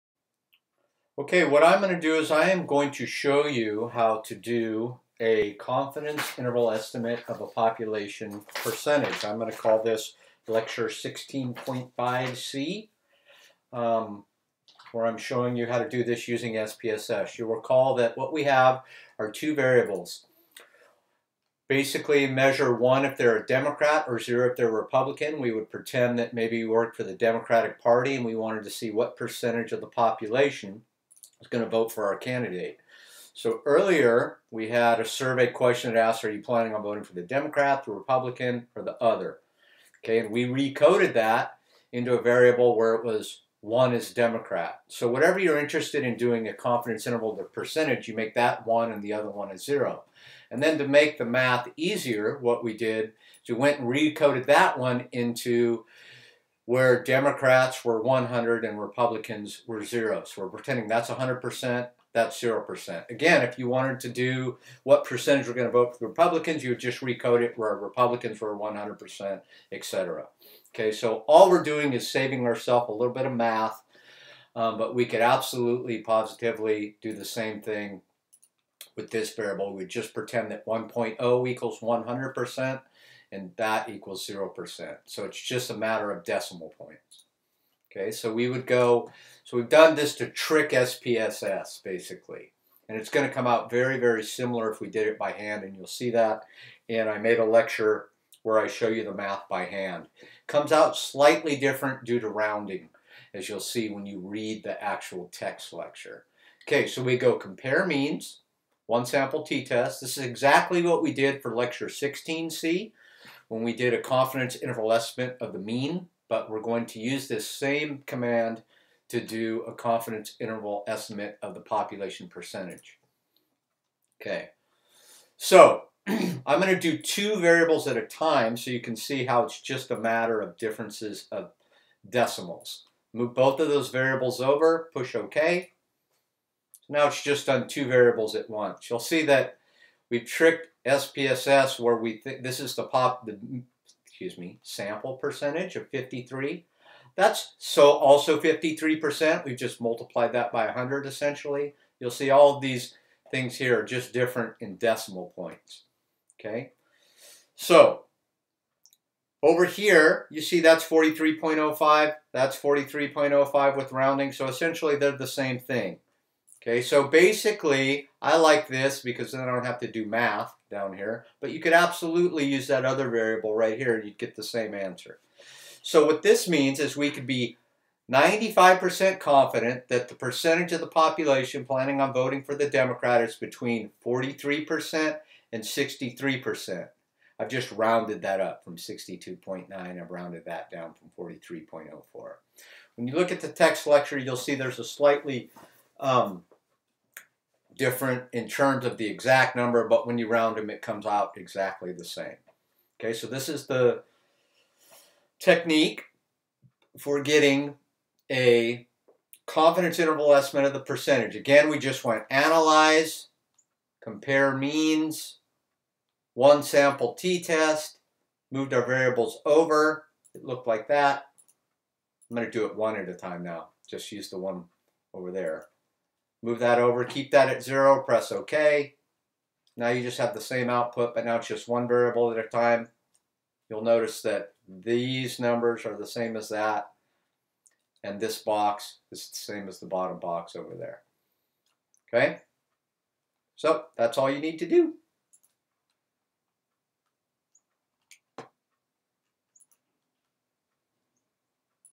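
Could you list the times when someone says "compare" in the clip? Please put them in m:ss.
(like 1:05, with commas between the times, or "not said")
1:47, 3:33.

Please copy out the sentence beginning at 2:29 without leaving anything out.
We've just multiplied that by 100 essentially.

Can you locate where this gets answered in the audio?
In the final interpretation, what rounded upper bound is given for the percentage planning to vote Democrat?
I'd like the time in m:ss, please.
3:05.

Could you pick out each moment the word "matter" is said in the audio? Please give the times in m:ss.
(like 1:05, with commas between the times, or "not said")
1:25, 2:09.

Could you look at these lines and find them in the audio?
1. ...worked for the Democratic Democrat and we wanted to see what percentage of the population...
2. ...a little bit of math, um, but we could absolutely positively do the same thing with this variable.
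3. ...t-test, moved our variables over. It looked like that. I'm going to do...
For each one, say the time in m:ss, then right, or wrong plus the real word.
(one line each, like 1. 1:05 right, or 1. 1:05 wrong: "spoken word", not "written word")
1. 0:26 wrong: "Party", not "Democrat"
2. 1:12 right
3. 3:37 right.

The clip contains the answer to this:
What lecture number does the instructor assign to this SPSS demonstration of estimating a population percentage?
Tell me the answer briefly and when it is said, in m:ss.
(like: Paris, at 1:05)
16.5C, at 0:10.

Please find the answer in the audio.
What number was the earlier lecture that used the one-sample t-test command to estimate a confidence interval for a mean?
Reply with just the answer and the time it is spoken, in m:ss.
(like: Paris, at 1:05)
16C, at 1:51.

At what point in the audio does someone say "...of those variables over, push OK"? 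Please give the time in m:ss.
2:13.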